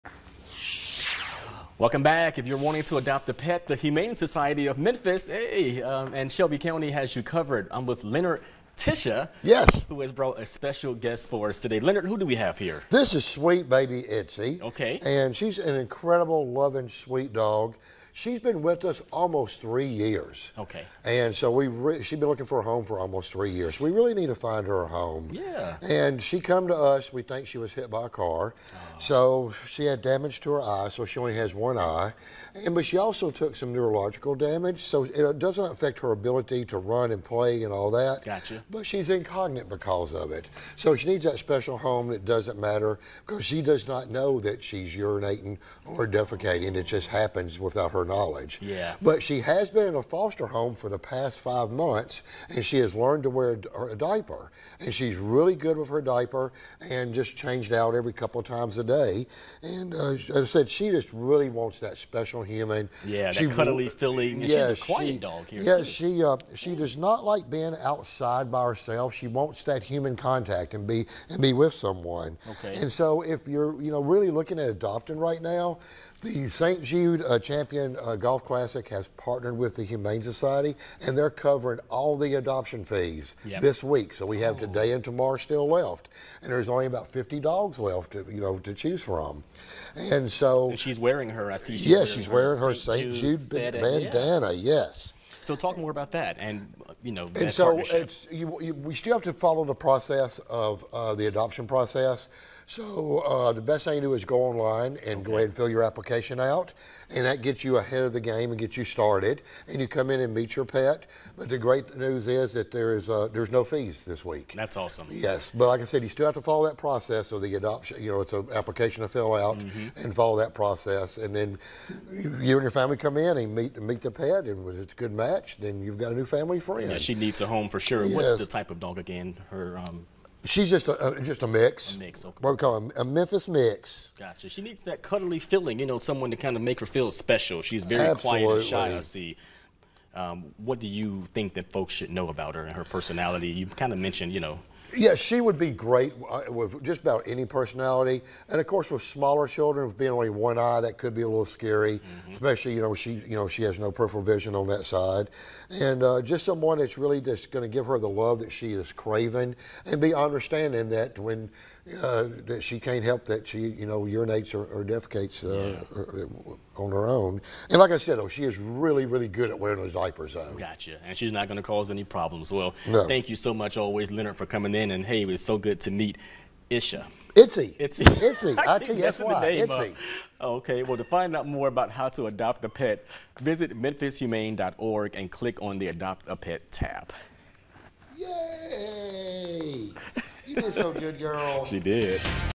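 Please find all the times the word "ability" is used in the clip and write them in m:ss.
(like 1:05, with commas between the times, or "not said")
0:36.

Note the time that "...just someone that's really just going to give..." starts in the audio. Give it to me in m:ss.
2:36.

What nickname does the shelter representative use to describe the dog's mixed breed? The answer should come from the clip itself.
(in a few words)
Memphis mix.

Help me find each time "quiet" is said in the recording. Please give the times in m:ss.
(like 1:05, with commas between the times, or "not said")
1:04, 2:18.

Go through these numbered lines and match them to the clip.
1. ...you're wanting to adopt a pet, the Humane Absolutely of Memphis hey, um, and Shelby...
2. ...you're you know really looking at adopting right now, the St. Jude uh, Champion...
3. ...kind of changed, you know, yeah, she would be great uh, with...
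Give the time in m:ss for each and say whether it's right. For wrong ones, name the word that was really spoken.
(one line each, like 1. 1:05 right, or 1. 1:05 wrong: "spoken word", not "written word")
1. 0:02 wrong: "Society", not "Absolutely"
2. 1:13 right
3. 2:23 wrong: "mentioned", not "changed".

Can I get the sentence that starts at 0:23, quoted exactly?
We really need to find her a home.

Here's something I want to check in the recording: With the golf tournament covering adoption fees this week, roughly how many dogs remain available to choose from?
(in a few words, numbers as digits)
50.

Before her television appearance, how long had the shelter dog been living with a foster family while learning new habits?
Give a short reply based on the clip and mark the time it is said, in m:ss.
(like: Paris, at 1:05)
5 months, at 0:51.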